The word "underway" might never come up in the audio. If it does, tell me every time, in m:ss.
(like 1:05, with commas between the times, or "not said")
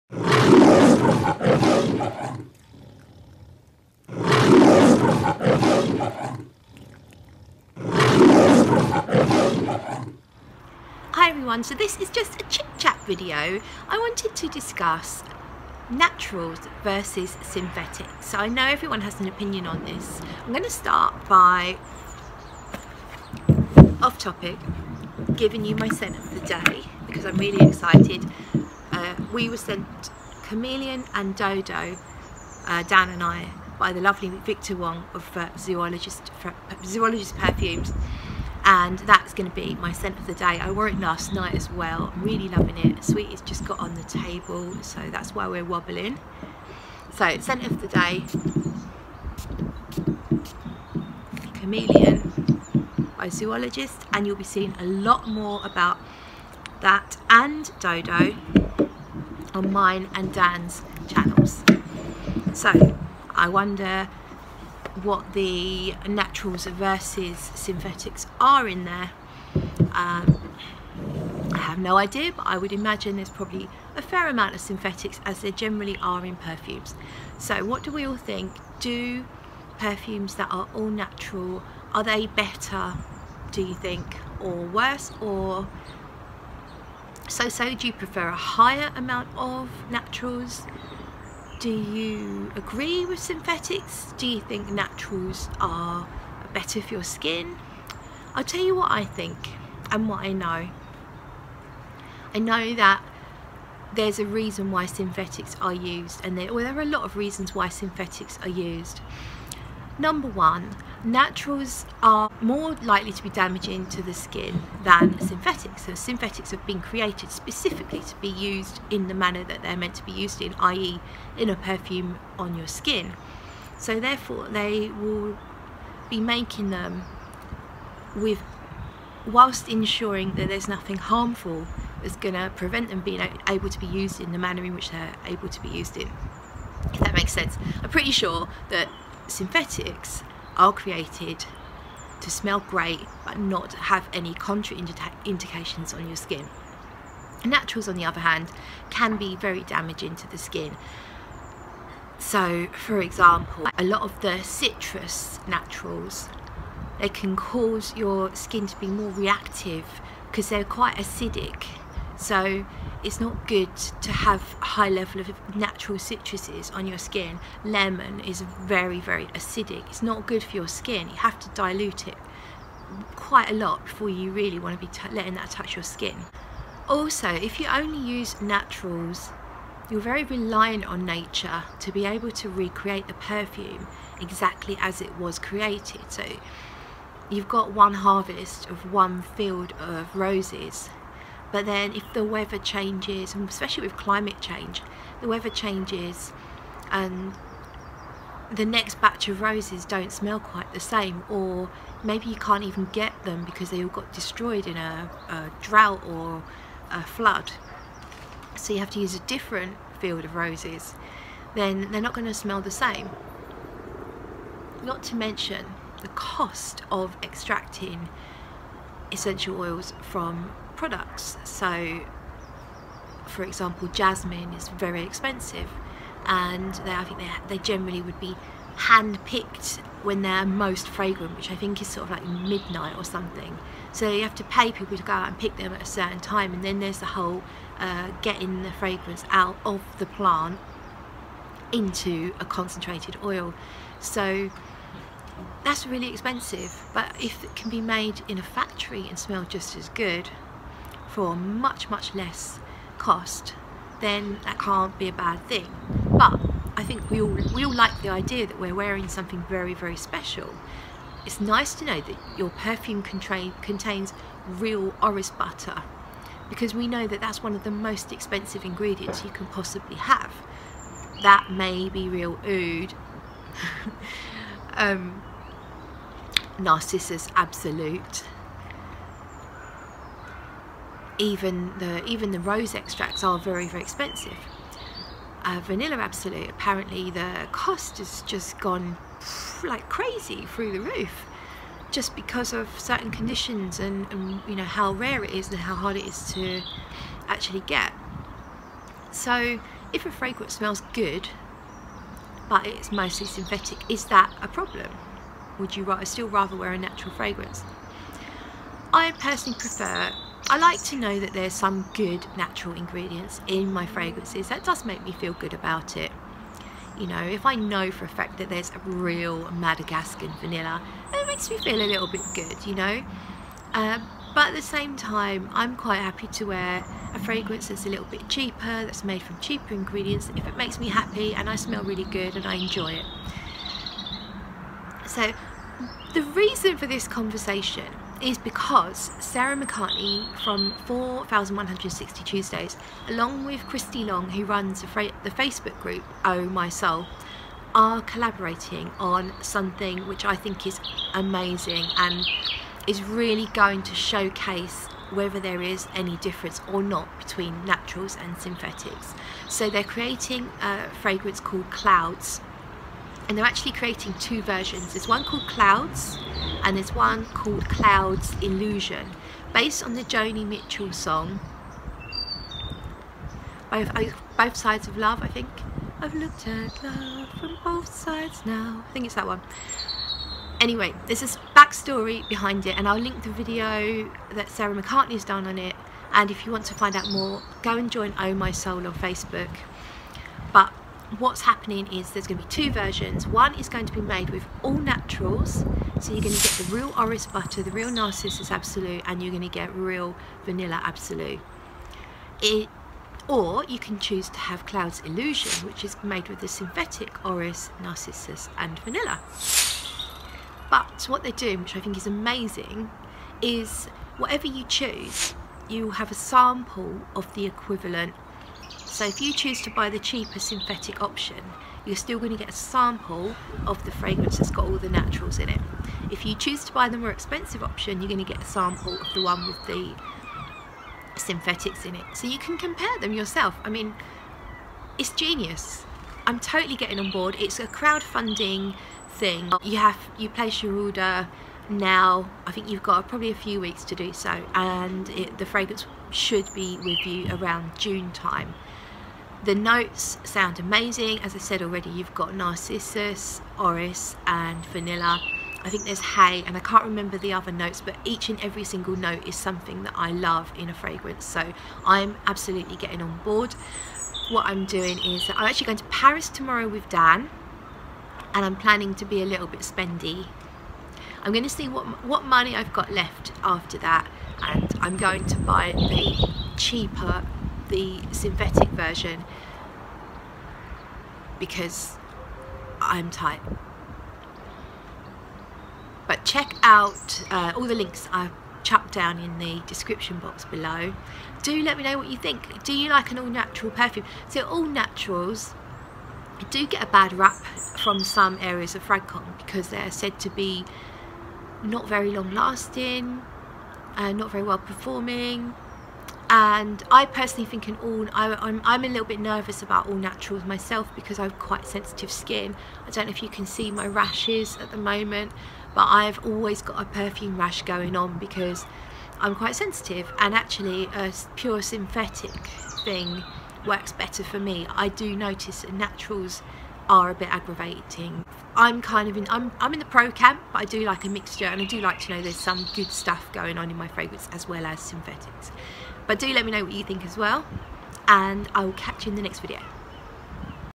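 not said.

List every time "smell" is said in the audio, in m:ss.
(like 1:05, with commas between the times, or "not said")
2:22, 3:20, 3:32, 4:09, 5:00, 5:31.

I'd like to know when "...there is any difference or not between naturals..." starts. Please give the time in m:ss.
5:55.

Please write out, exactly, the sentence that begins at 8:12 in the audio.
Do you like an all natural perfume?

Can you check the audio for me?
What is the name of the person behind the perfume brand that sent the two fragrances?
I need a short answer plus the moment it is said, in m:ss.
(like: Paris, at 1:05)
Victor Wong, at 0:34.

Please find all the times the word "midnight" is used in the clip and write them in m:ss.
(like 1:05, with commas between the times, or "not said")
3:52.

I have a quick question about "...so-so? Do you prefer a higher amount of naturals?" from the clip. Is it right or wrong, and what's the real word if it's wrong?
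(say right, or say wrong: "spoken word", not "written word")
right.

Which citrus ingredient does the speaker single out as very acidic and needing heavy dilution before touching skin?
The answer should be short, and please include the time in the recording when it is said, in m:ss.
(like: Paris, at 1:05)
Lemon, at 2:47.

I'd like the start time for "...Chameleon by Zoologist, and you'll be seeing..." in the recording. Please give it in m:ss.
0:51.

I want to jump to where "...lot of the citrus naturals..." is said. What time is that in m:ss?
2:33.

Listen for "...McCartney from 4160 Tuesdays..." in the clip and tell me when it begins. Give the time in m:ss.
5:39.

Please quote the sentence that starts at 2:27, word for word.
Naturals, on the other hand, can be very damaging to the skin.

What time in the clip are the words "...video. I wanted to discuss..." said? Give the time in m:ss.
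0:13.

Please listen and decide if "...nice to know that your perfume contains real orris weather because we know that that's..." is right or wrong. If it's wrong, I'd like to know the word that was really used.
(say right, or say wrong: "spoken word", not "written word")
wrong: "butter", not "weather".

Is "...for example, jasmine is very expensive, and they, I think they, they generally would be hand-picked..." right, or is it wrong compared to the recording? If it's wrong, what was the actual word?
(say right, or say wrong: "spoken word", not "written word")
right.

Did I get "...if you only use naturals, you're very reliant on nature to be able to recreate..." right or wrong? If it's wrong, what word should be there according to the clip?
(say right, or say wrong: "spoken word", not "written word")
right.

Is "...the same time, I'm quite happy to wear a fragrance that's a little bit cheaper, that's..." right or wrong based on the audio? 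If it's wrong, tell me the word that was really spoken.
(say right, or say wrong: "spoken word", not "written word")
right.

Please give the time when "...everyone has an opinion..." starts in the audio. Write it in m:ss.
0:18.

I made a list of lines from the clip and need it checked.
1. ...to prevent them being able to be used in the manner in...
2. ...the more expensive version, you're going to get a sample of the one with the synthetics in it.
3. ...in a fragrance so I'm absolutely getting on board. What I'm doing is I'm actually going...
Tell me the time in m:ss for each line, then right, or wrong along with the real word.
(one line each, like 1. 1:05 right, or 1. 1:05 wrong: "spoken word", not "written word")
1. 2:12 right
2. 7:06 wrong: "option", not "version"
3. 7:40 right.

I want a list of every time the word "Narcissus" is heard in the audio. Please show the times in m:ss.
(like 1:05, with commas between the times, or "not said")
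4:36, 6:37, 6:47, 7:32.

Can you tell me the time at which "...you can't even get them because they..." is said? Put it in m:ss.
3:22.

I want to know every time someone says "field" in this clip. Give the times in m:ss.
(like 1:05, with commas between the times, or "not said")
3:09, 3:30.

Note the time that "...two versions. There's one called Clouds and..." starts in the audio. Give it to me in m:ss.
6:04.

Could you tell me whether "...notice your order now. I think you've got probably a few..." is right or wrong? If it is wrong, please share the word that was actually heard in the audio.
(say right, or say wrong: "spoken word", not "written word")
wrong: "place", not "notice".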